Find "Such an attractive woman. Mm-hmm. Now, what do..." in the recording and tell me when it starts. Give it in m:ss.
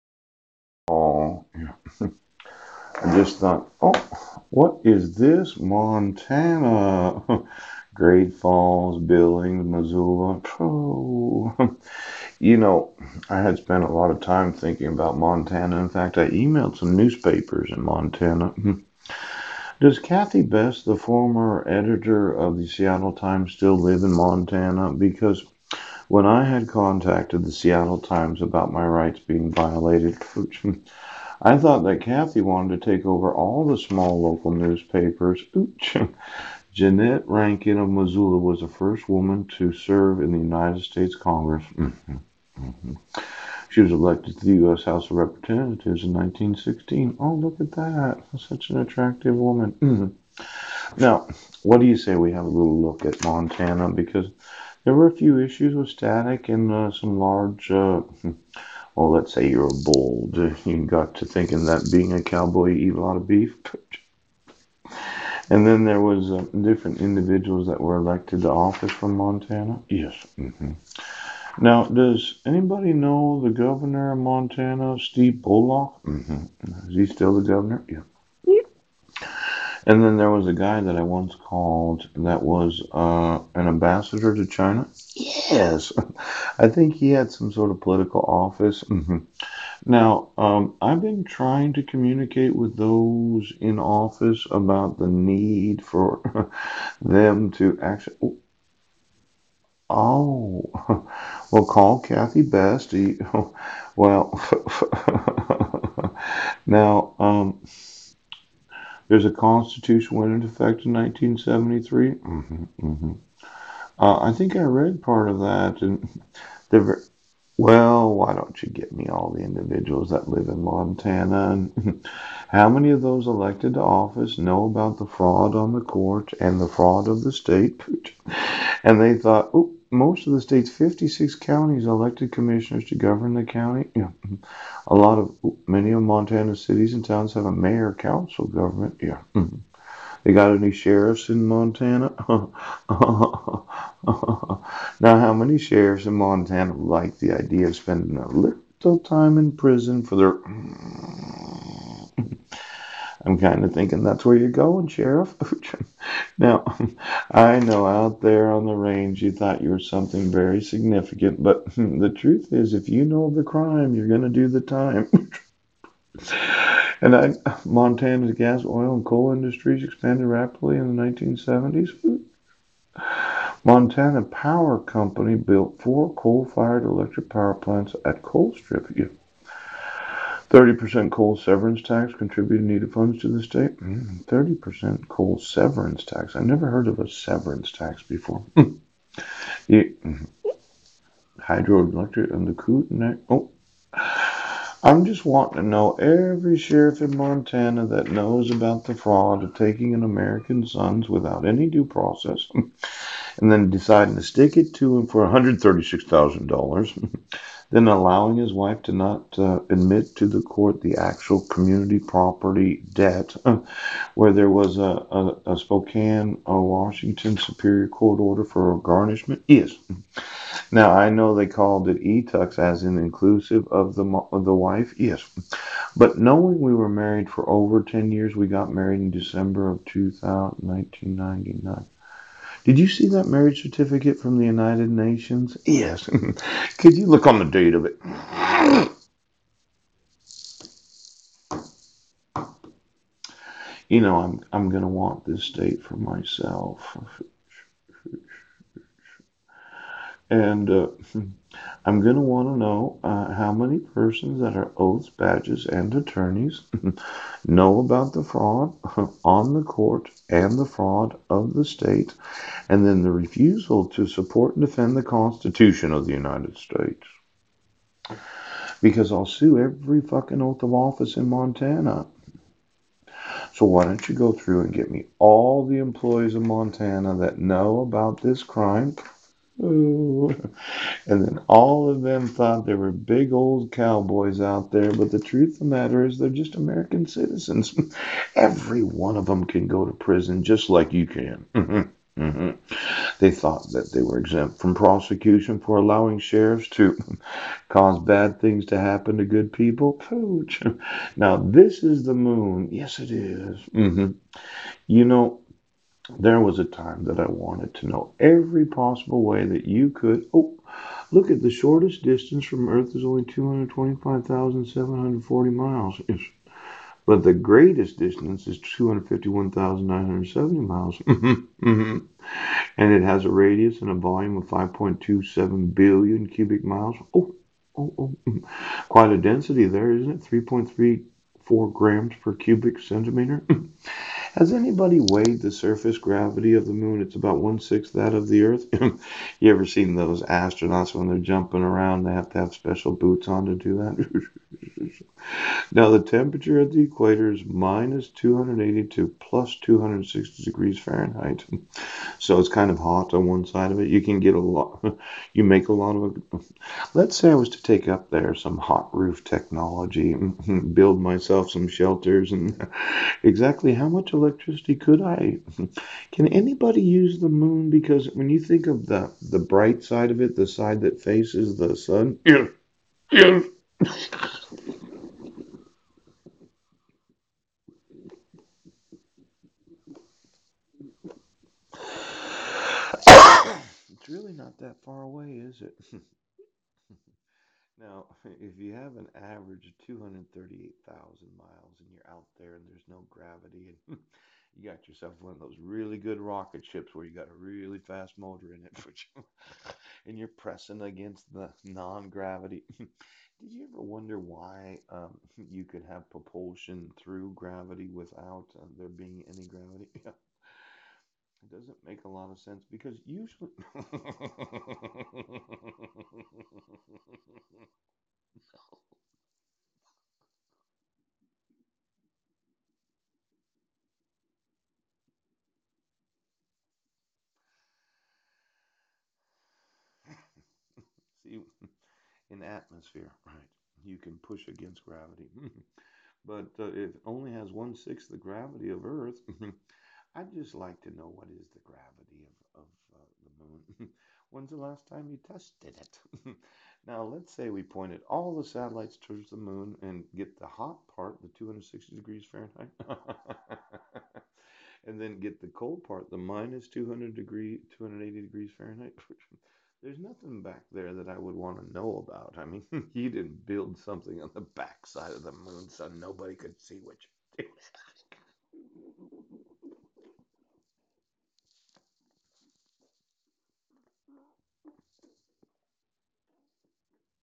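0:48.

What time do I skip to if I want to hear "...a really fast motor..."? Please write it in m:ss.
6:37.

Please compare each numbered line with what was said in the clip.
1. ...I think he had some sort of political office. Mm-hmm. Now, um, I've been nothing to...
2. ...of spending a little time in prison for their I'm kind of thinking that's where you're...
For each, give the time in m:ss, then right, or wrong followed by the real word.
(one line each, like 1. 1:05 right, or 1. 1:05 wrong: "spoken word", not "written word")
1. 1:26 wrong: "trying", not "nothing"
2. 2:27 right.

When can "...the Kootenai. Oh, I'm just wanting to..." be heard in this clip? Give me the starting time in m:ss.
3:12.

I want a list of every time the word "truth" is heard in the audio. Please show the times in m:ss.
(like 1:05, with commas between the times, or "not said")
2:42, 4:45.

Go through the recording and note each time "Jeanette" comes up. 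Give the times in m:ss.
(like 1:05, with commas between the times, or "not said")
0:36.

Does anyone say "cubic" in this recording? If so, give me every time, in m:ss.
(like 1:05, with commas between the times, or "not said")
5:26, 5:32.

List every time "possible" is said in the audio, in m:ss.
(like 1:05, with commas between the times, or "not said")
5:08.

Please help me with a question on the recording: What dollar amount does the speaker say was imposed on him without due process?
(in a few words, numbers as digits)
$136,000.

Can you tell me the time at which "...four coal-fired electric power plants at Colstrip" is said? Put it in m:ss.
2:55.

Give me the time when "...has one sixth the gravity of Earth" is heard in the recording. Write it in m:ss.
7:17.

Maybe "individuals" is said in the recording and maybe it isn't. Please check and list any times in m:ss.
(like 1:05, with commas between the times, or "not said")
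1:06, 1:59.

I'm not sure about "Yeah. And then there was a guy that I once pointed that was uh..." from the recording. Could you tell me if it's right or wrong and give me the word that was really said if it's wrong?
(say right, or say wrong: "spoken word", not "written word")
wrong: "called", not "pointed".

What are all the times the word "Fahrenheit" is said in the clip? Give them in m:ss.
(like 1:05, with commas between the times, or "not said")
5:50, 7:32, 7:38.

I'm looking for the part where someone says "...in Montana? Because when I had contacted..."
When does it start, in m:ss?
0:24.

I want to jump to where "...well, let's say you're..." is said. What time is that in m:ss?
0:58.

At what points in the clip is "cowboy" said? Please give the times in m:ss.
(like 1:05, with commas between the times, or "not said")
1:02, 4:43.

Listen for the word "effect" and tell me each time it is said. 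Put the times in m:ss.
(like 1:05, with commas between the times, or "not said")
1:50.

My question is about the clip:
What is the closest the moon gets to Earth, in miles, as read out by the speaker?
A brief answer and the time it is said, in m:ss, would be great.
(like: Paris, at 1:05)
225,740 miles, at 5:13.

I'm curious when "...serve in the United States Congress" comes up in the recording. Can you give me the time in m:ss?
0:39.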